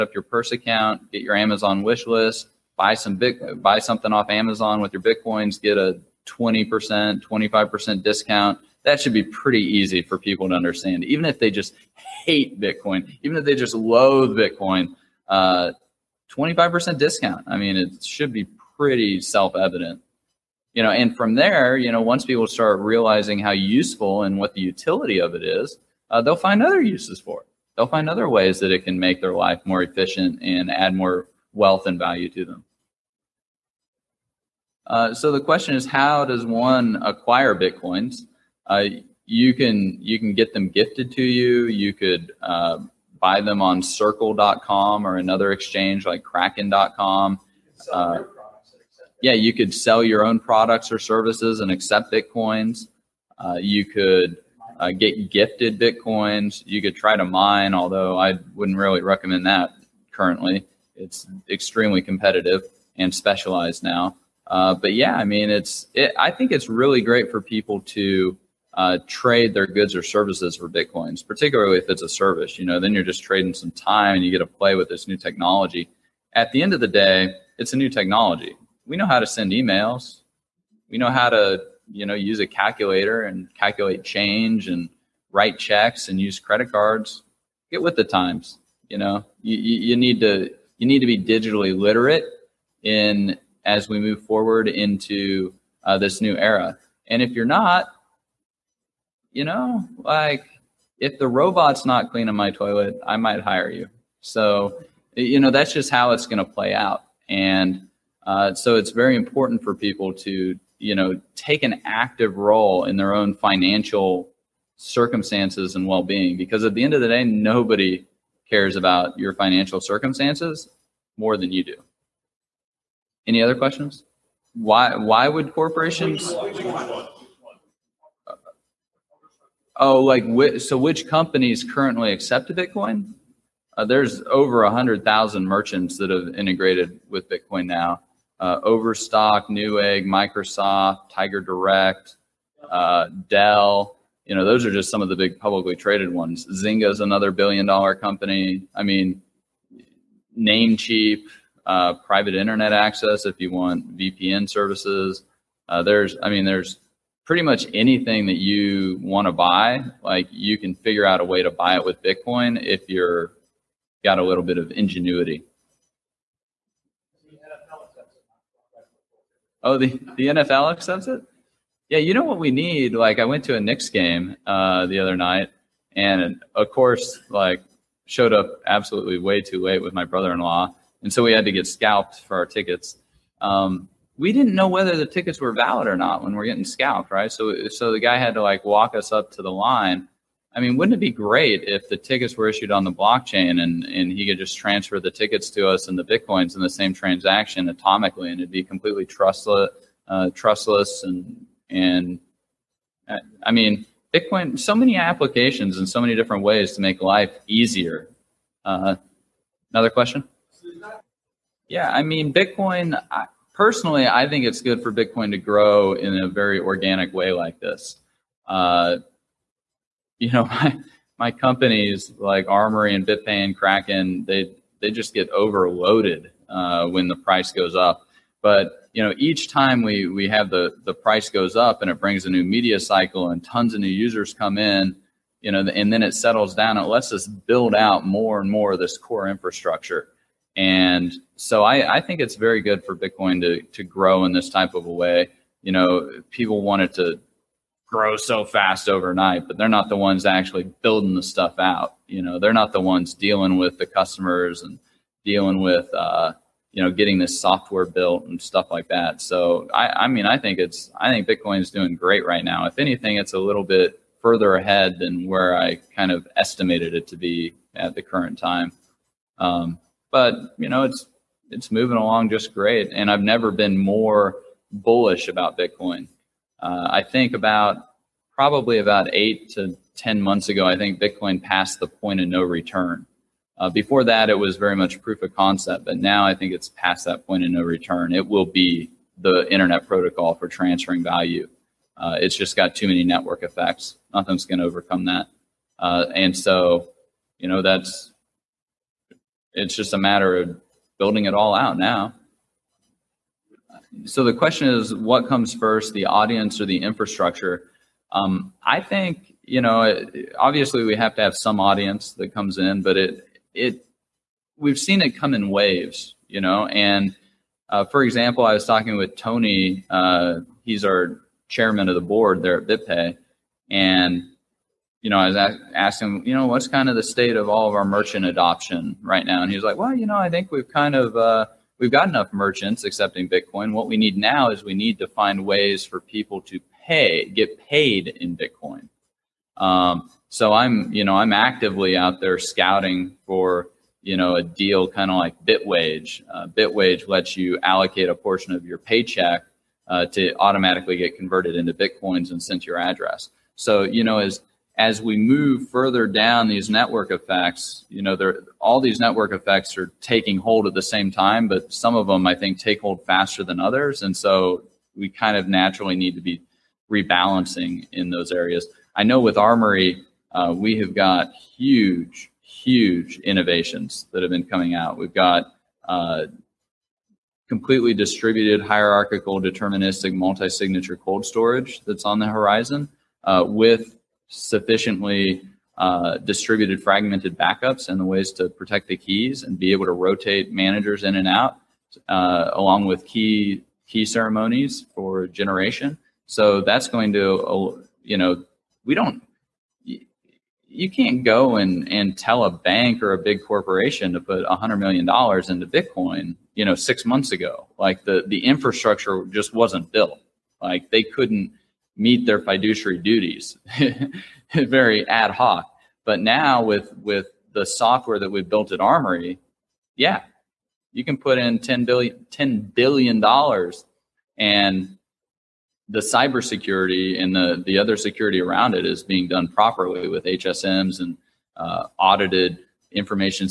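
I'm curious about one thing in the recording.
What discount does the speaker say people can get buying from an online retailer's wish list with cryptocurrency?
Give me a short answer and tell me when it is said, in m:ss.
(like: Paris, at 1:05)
20%, 25%, at 0:06.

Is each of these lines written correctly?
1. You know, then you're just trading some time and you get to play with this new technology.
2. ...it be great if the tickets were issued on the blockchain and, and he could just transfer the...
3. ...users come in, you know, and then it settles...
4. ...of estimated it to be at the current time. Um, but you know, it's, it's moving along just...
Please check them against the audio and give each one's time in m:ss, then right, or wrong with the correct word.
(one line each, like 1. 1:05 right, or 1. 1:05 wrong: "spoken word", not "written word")
1. 1:12 right
2. 3:10 right
3. 3:53 right
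4. 4:26 right.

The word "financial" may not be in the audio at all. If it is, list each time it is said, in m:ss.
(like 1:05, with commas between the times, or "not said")
1:53, 1:59.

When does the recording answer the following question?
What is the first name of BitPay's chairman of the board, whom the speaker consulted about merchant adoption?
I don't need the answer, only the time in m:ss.
5:19.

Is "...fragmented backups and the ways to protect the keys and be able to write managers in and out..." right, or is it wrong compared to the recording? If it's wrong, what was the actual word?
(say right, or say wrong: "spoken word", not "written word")
wrong: "rotate", not "write".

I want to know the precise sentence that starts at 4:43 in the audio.
Uh, before that, it was very much proof of concept, but now I think it's past that point of no return.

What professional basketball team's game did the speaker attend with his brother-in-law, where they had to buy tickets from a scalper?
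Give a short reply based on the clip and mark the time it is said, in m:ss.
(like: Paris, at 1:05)
Knicks, at 2:53.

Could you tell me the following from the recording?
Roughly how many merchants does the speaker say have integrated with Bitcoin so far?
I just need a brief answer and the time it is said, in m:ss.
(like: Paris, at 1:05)
Over 100,000, at 2:14.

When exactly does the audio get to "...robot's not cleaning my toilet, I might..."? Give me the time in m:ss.
1:41.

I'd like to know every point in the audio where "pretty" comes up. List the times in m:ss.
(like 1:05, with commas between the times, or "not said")
0:09, 0:18, 2:37.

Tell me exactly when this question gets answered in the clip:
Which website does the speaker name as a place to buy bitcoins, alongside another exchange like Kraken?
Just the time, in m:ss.
0:43.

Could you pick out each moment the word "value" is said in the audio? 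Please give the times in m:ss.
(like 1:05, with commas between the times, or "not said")
0:31, 4:51.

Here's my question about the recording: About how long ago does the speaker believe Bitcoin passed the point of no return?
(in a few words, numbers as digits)
8 to 10 months.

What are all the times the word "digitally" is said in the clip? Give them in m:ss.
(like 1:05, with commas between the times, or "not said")
1:31.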